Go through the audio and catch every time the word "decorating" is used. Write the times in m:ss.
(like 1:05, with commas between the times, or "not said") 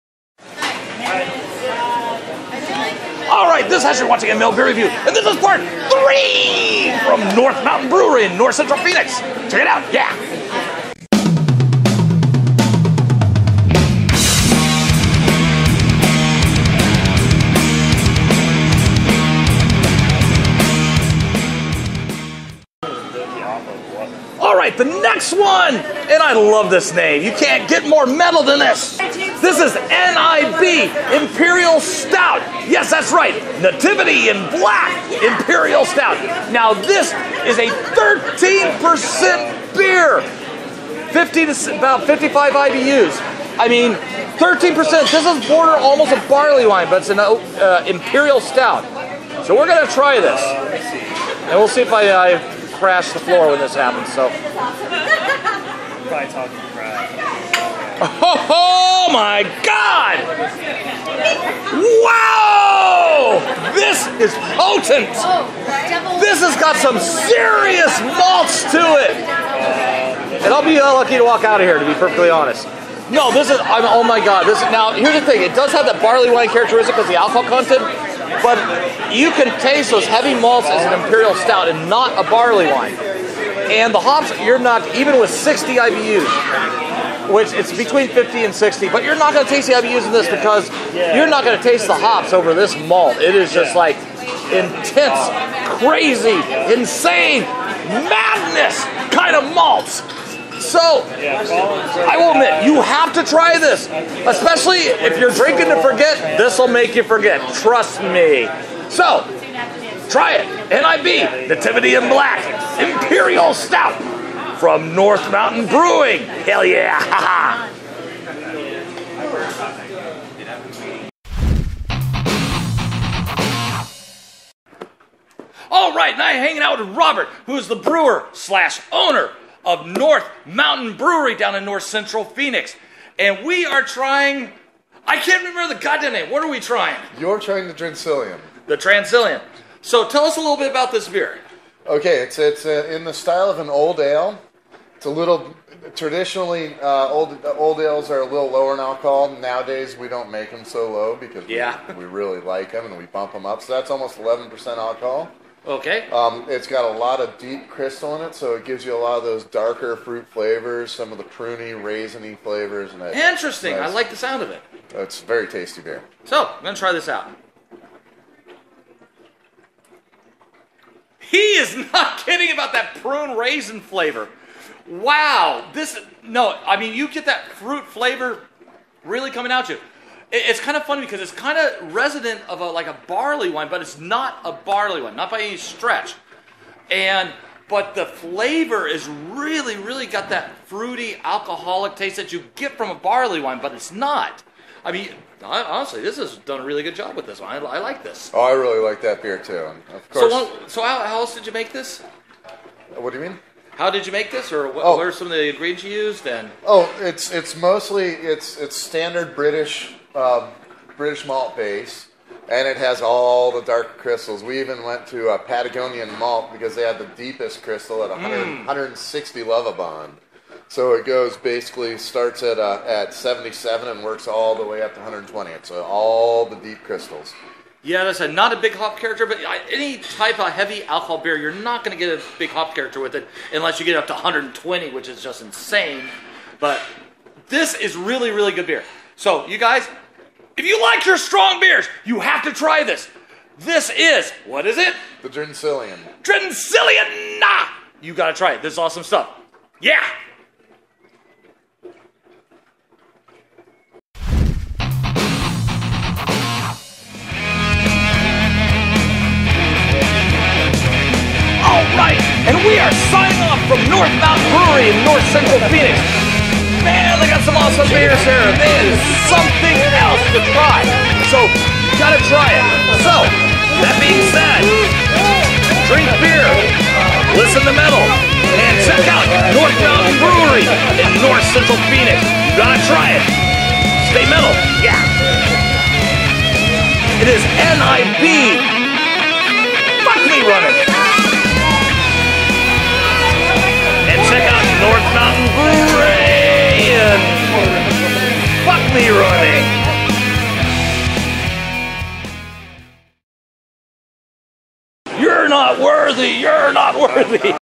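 not said.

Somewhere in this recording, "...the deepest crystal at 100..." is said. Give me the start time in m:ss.
3:36.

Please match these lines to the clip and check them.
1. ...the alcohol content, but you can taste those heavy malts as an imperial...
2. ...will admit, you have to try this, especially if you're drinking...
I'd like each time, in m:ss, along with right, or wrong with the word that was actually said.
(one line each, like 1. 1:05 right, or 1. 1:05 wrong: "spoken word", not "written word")
1. 1:17 right
2. 1:42 right.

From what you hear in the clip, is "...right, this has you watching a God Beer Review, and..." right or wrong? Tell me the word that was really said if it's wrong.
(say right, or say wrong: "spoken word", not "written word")
wrong: "Mill", not "God".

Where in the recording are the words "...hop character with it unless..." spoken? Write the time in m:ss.
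3:52.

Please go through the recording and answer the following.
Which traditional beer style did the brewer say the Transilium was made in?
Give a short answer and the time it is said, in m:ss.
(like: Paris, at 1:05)
old ale, at 2:23.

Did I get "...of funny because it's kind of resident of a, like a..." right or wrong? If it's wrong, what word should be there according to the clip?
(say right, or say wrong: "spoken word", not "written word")
right.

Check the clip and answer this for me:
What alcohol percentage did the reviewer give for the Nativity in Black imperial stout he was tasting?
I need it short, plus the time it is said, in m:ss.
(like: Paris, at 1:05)
13%, at 0:36.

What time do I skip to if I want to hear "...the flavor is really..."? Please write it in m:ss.
3:07.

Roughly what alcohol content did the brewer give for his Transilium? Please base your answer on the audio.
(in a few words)
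almost 11%.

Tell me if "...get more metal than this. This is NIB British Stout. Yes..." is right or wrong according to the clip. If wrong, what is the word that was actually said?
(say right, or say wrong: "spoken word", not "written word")
wrong: "Imperial", not "British".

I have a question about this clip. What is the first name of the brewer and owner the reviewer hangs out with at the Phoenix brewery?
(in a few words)
Robert.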